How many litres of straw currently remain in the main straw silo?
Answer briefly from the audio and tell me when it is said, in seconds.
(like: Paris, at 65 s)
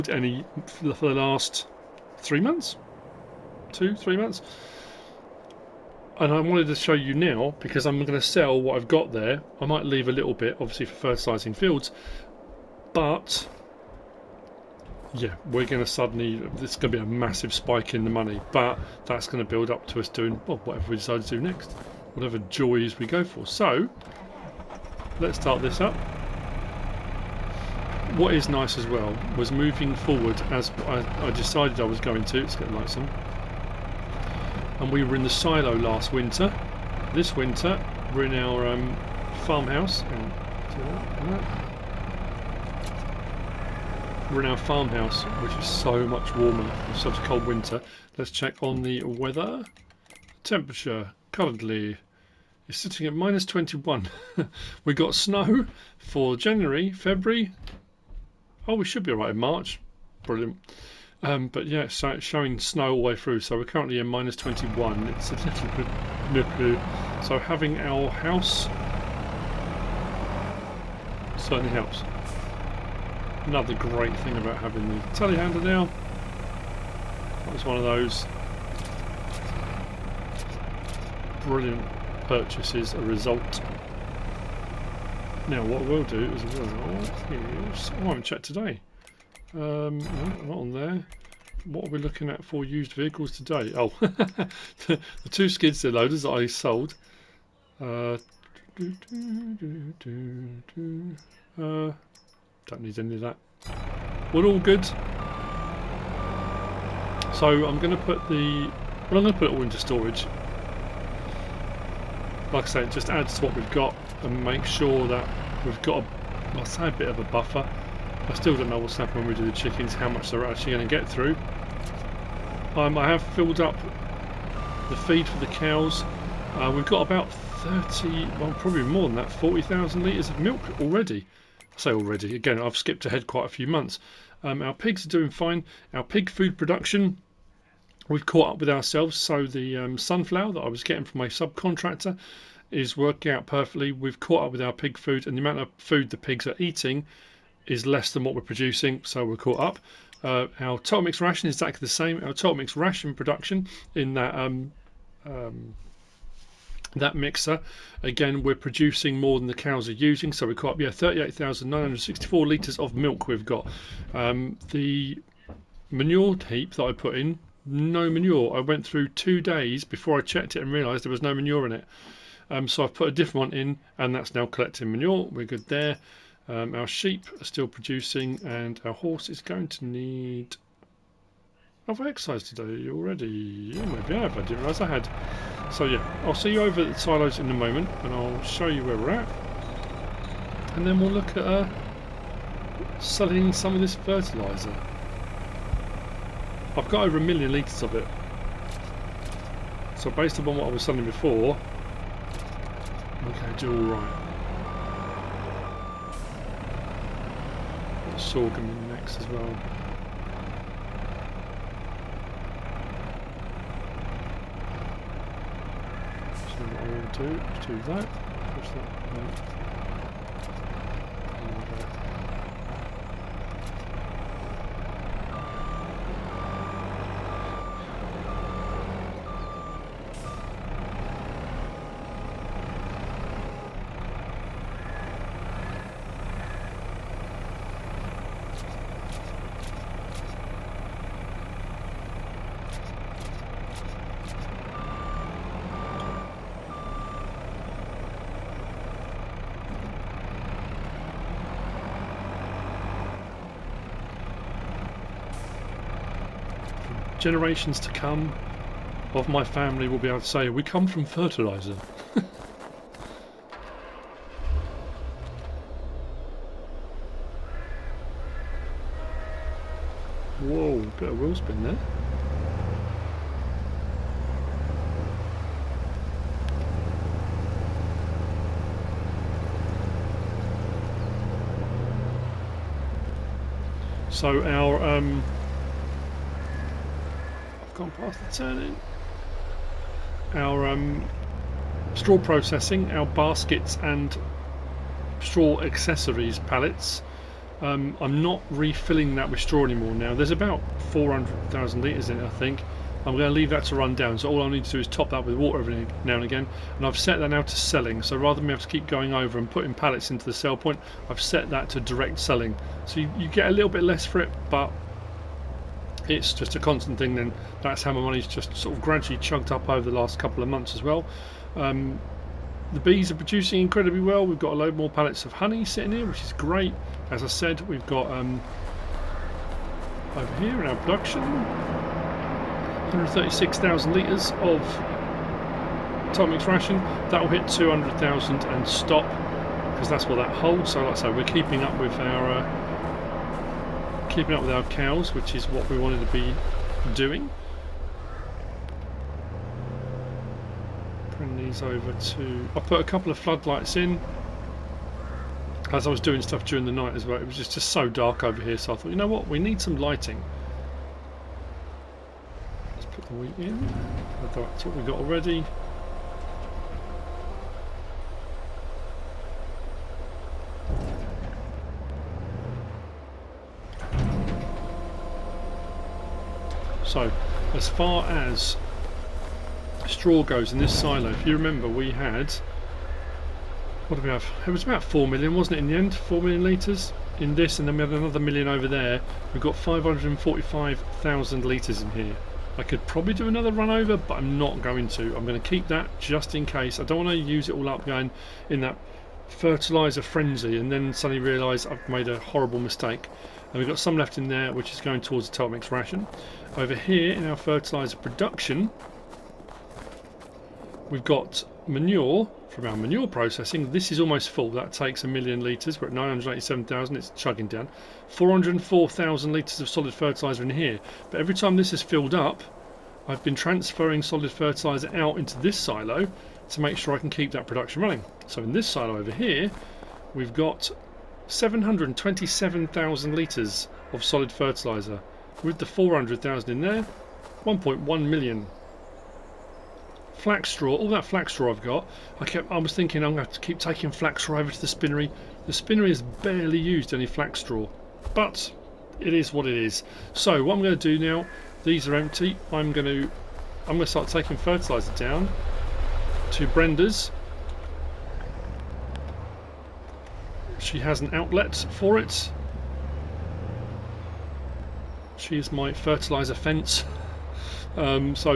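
545,000 litres, at 389 s.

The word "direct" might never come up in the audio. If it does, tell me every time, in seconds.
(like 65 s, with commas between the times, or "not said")
311 s.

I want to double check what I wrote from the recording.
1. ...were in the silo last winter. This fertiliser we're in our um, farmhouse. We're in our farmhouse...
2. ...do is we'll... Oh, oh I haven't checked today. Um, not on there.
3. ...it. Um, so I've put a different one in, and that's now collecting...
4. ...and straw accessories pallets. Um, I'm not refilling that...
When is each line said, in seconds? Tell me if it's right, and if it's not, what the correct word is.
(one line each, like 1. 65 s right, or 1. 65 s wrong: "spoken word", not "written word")
1. 35 s wrong: "winter", not "fertiliser"
2. 86 s right
3. 171 s right
4. 293 s right.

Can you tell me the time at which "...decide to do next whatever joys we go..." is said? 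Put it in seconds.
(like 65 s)
20 s.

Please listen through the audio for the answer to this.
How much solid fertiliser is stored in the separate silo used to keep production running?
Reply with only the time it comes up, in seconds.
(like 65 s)
431 s.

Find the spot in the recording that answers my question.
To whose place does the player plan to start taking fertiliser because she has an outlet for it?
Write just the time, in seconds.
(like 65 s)
456 s.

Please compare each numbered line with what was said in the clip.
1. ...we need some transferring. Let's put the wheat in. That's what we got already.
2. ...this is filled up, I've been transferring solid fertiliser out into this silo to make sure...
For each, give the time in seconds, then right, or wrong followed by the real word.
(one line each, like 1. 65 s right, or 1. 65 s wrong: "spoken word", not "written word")
1. 359 s wrong: "lighting", not "transferring"
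2. 421 s right.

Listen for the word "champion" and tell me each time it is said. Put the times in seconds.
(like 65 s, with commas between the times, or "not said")
not said.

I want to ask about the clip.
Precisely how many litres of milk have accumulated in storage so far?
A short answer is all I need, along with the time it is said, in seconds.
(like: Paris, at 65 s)
38,964 litres, at 160 s.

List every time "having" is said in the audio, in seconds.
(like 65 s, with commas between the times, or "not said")
67 s, 74 s.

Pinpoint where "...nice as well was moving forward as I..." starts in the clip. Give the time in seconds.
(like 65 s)
28 s.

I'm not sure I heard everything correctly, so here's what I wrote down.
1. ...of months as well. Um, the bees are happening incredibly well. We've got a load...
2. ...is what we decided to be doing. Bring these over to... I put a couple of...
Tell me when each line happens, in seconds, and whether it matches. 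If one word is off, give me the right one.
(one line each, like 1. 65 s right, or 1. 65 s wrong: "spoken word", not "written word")
1. 320 s wrong: "producing", not "happening"
2. 345 s wrong: "wanted", not "decided".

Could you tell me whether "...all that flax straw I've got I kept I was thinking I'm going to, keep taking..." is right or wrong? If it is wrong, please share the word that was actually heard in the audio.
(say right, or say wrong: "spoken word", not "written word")
right.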